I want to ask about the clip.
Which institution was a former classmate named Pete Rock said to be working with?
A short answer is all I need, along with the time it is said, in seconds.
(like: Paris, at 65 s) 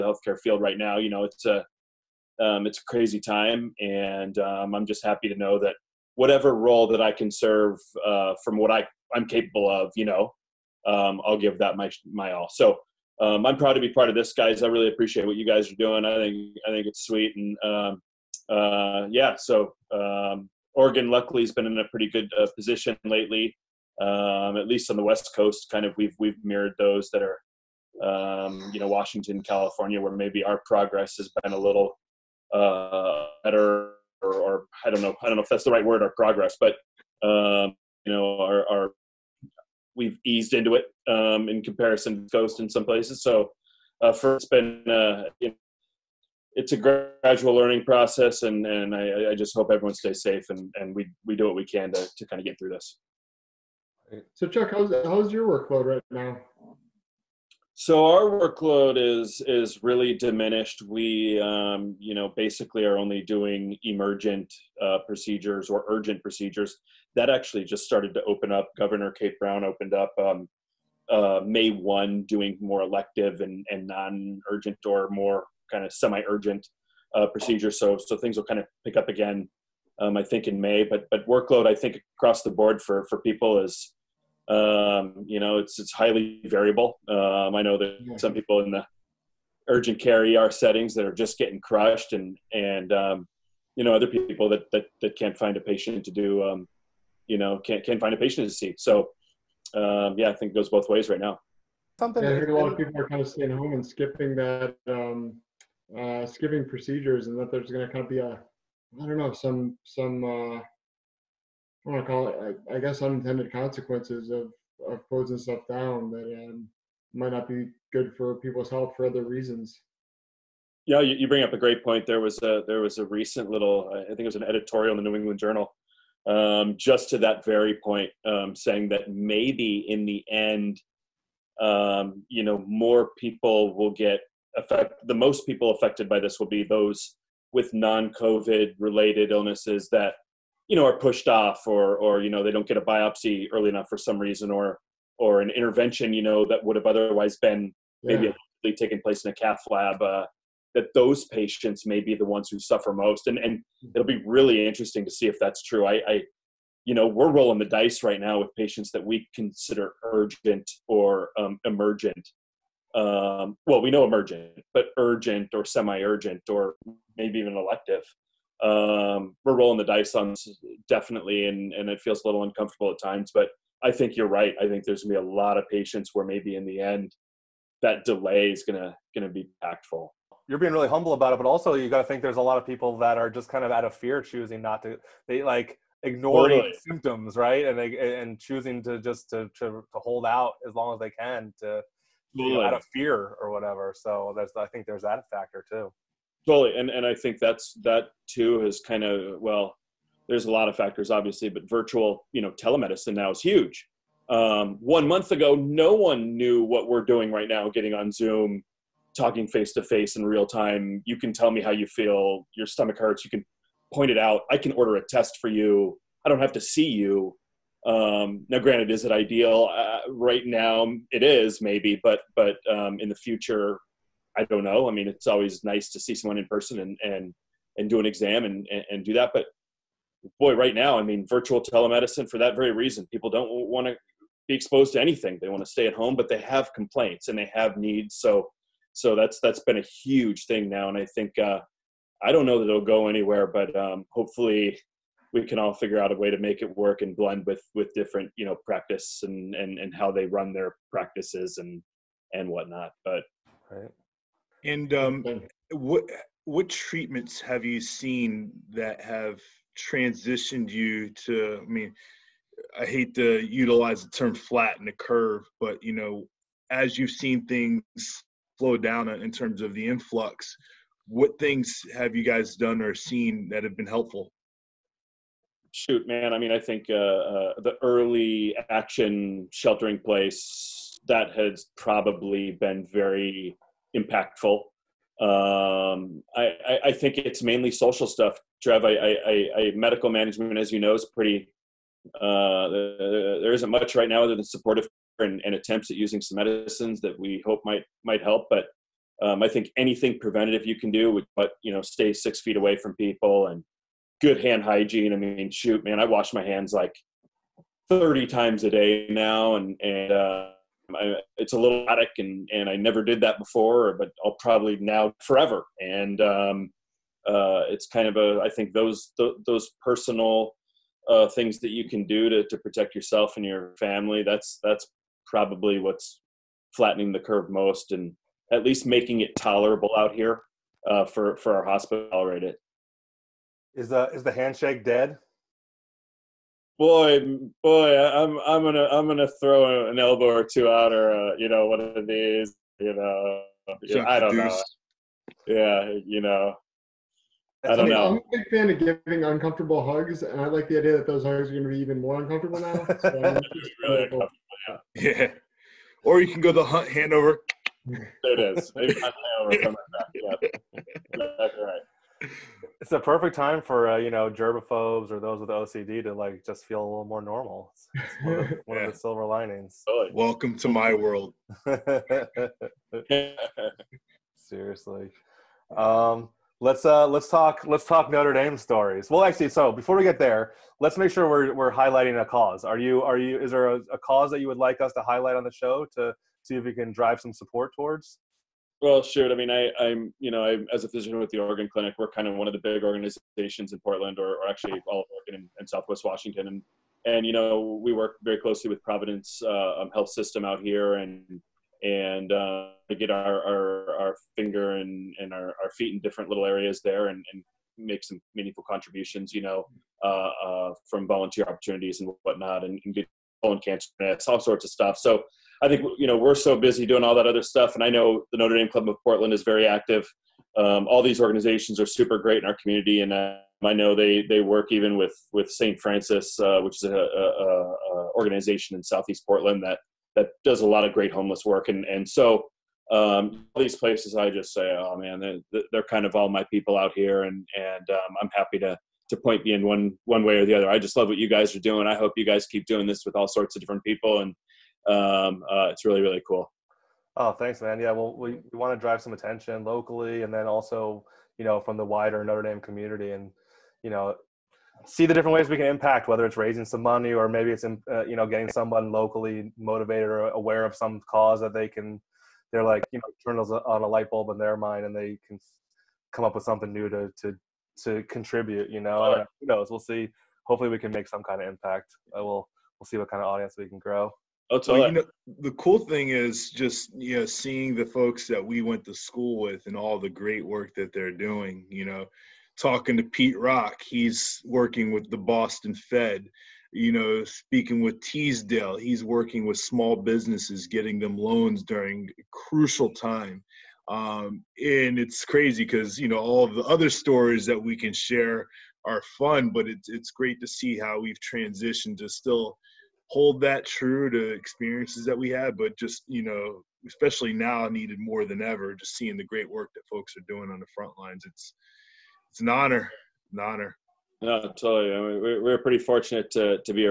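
Boston Fed, at 485 s.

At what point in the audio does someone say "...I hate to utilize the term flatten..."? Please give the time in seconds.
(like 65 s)
262 s.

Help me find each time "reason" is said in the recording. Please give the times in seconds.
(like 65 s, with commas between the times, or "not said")
119 s, 144 s, 232 s.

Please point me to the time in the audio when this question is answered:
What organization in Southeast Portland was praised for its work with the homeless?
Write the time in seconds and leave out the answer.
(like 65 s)
425 s.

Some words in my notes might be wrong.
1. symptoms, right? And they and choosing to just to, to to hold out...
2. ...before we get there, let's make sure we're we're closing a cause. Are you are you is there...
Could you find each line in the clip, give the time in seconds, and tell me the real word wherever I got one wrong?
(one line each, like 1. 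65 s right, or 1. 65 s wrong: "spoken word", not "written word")
1. 186 s right
2. 379 s wrong: "highlighting", not "closing".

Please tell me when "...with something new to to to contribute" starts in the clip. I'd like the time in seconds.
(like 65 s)
466 s.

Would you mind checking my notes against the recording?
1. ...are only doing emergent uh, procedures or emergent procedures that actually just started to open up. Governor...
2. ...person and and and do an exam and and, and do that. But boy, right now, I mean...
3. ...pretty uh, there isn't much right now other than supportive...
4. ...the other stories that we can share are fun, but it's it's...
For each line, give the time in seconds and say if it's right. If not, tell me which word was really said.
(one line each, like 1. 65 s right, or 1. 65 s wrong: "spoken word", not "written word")
1. 62 s wrong: "urgent", not "emergent"
2. 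226 s right
3. 291 s right
4. 496 s right.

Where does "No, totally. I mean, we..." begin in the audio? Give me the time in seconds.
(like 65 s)
514 s.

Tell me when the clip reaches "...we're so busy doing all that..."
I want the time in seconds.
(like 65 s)
416 s.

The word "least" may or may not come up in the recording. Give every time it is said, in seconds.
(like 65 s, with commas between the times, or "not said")
24 s, 328 s.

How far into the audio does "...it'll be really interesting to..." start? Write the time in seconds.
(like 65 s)
153 s.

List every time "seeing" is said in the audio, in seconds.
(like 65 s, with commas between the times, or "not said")
477 s, 508 s.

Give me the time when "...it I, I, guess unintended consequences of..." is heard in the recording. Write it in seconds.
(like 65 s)
112 s.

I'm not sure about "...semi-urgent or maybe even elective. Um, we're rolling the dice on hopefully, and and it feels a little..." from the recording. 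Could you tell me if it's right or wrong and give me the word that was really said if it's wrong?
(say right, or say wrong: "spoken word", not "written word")
wrong: "definitely", not "hopefully".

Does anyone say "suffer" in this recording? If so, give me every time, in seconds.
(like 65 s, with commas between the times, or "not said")
152 s.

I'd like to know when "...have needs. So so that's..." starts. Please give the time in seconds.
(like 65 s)
237 s.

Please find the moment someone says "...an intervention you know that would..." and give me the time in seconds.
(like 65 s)
145 s.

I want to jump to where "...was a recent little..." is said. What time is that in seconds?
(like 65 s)
122 s.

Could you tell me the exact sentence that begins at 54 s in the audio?
So Chuck, how's how's your workload right now?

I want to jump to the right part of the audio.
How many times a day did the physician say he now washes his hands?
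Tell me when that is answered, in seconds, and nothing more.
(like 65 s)
307 s.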